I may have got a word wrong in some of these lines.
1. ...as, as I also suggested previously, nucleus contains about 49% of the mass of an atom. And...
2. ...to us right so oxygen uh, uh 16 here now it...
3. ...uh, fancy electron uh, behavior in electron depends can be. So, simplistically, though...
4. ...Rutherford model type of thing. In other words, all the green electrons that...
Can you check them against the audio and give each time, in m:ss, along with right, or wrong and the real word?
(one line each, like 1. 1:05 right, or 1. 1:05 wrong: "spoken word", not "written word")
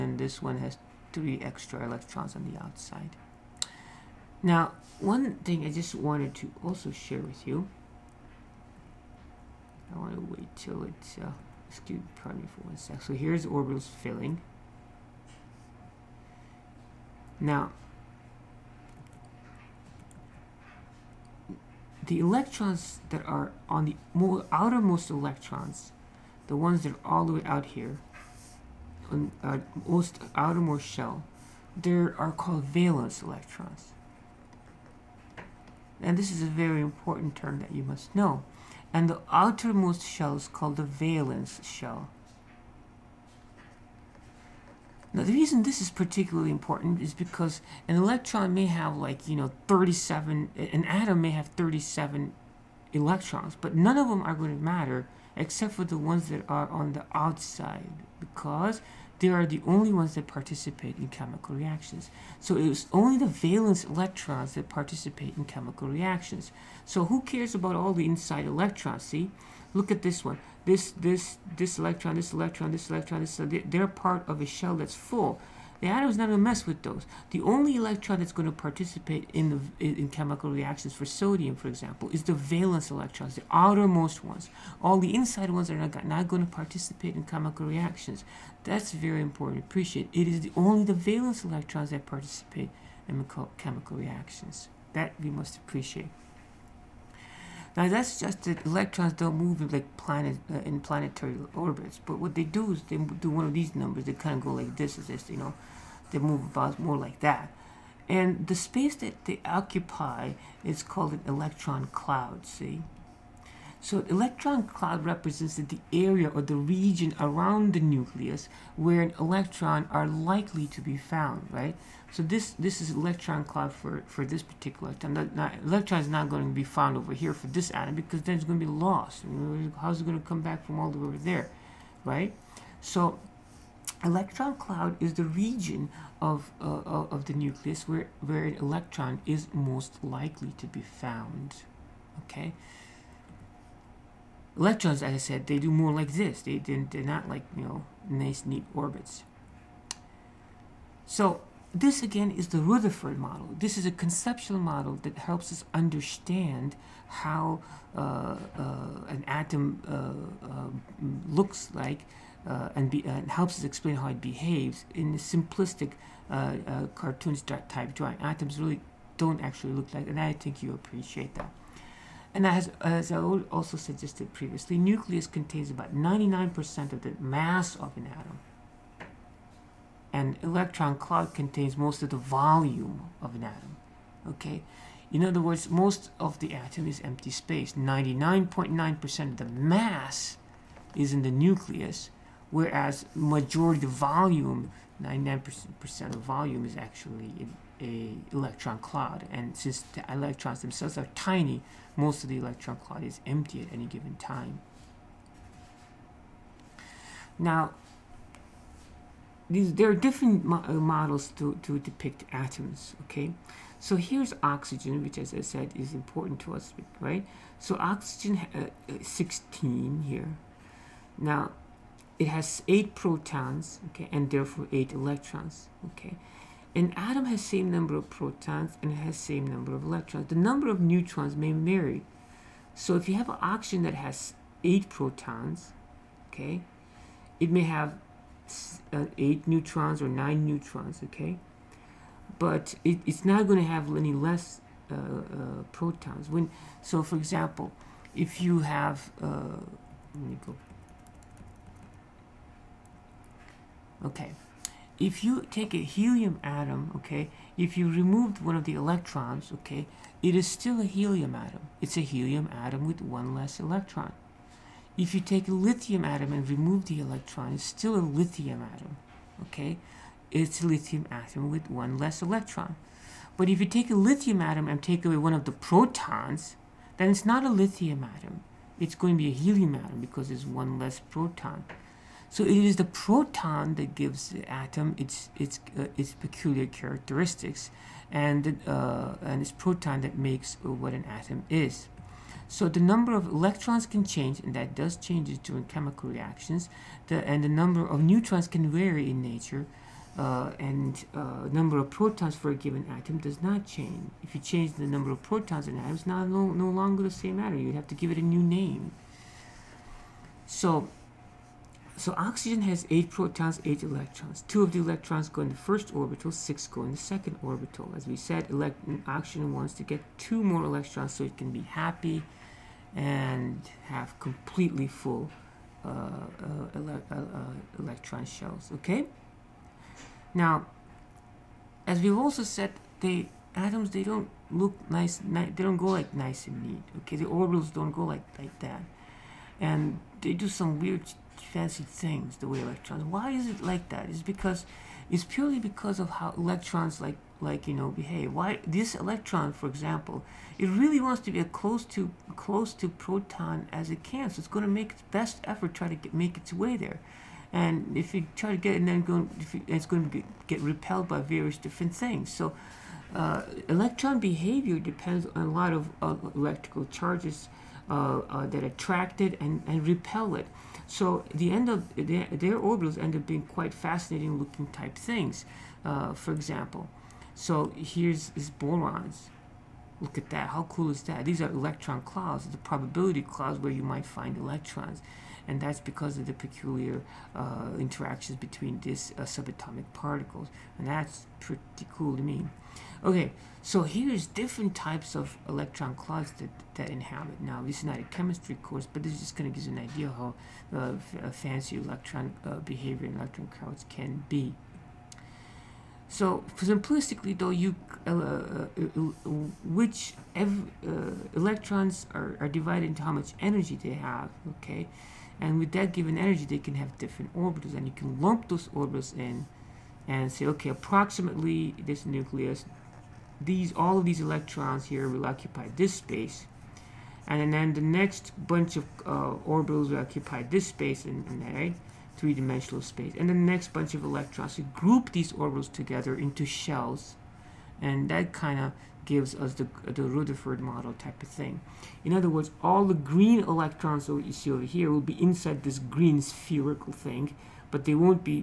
1. 2:52 wrong: "99", not "49"
2. 3:36 right
3. 6:40 wrong: "clouds", not "depends"
4. 7:20 right.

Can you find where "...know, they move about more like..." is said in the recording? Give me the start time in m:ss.
1:45.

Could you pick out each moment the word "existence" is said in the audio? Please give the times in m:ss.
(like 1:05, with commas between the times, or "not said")
not said.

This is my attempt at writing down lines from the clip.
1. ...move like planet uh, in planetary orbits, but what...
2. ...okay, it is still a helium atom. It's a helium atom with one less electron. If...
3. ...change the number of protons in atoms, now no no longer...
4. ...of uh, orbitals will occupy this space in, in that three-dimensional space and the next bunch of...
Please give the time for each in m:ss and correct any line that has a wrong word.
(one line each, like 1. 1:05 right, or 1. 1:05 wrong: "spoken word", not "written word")
1. 1:39 right
2. 4:19 right
3. 5:04 right
4. 7:08 right.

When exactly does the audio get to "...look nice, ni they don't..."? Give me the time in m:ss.
5:34.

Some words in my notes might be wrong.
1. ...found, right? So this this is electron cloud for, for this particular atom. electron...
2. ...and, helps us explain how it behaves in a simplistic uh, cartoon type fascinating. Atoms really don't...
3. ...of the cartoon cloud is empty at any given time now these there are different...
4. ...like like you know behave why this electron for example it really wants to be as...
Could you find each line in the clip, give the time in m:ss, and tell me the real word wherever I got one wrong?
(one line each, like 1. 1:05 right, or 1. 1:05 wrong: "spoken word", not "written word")
1. 2:00 right
2. 2:43 wrong: "drawing", not "fascinating"
3. 3:22 wrong: "electron", not "cartoon"
4. 5:46 right.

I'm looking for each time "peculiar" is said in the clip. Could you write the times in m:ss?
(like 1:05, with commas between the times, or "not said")
4:46, 6:26.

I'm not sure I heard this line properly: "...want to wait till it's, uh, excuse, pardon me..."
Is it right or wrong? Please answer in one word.
right.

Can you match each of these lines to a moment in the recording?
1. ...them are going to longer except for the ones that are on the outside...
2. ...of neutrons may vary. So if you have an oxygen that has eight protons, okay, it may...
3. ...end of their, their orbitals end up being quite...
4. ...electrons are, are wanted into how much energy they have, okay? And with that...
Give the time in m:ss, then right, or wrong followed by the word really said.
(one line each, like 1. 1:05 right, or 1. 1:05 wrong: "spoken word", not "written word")
1. 0:54 wrong: "matter", not "longer"
2. 3:50 right
3. 6:11 right
4. 6:51 wrong: "divided", not "wanted".